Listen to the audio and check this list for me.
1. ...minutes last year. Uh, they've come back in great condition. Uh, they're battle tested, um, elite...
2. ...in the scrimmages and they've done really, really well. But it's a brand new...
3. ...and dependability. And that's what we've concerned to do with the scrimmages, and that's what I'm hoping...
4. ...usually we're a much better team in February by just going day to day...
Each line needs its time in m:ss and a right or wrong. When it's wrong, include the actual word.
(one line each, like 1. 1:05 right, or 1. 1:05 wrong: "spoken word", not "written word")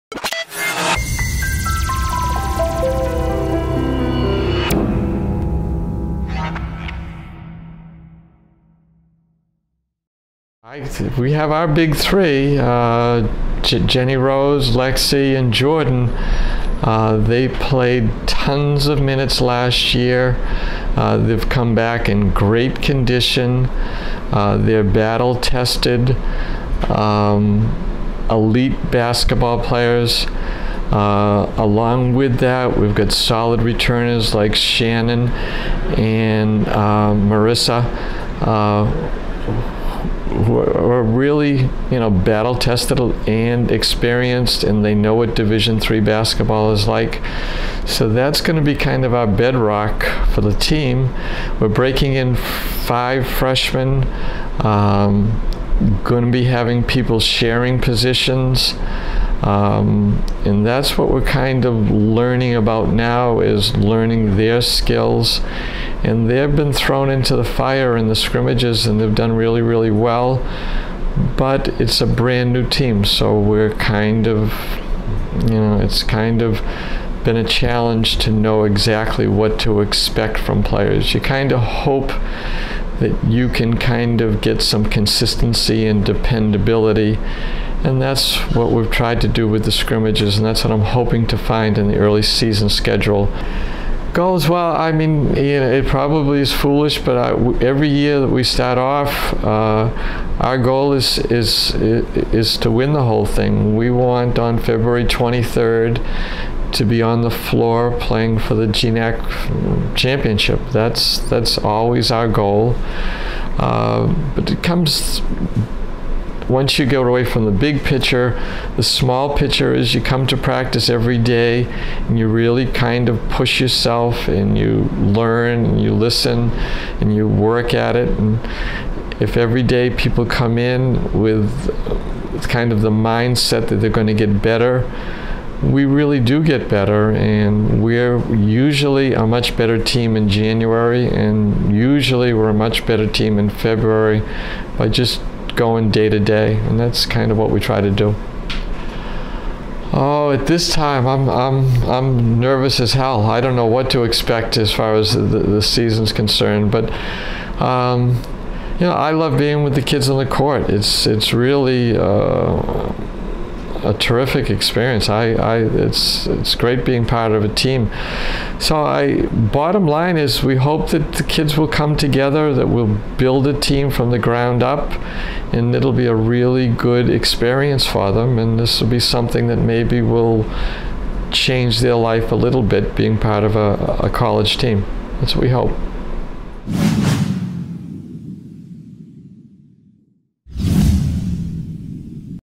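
1. 0:19 right
2. 1:07 right
3. 1:25 wrong: "tried", not "concerned"
4. 2:21 right.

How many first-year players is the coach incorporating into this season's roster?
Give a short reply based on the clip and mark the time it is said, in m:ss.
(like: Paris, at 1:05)
5, at 0:52.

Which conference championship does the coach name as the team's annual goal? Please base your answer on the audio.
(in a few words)
GNAC.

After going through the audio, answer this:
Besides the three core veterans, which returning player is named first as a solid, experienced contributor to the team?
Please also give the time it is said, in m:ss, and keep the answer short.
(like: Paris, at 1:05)
Shannon, at 0:34.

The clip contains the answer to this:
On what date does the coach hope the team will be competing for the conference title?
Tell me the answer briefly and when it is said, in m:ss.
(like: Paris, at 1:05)
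February 23rd, at 1:44.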